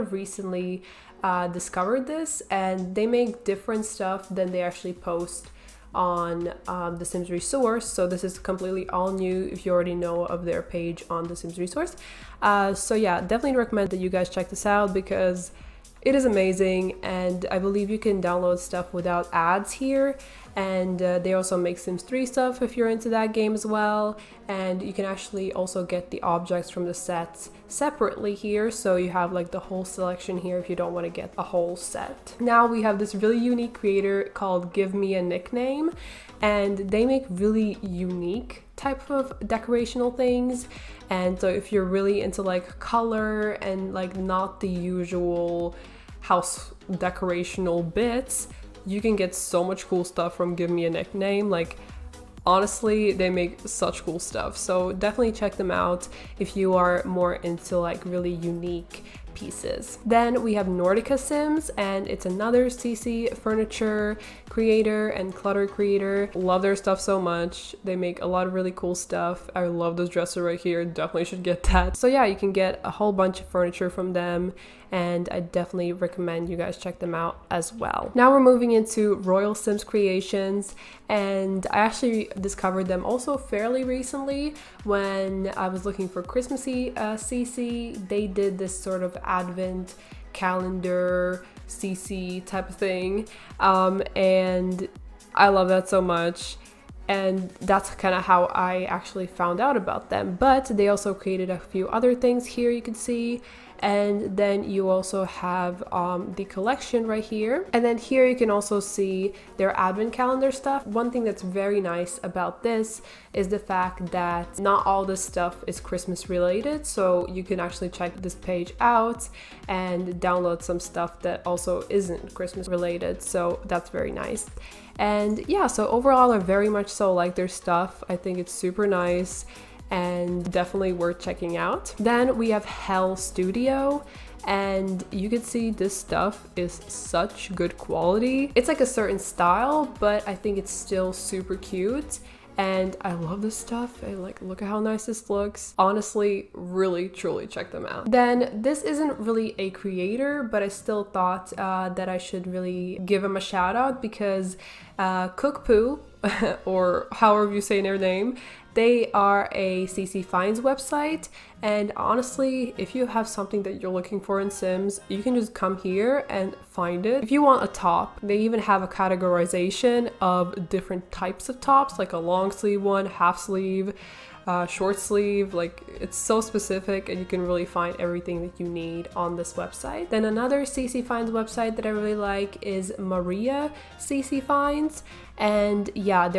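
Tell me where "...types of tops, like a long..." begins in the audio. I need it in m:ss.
2:51.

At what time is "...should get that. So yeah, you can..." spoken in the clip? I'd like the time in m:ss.
1:11.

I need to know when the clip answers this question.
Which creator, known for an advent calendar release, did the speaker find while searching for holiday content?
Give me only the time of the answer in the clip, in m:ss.
1:19.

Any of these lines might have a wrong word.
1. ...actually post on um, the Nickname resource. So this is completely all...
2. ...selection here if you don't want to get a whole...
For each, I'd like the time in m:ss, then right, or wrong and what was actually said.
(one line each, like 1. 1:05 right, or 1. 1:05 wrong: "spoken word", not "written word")
1. 0:04 wrong: "Sims", not "Nickname"
2. 0:29 right.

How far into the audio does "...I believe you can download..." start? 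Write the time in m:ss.
0:17.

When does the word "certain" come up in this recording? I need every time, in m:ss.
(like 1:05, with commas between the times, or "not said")
2:18.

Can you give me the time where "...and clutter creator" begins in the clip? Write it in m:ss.
1:05.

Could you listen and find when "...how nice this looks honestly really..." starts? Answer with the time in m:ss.
2:24.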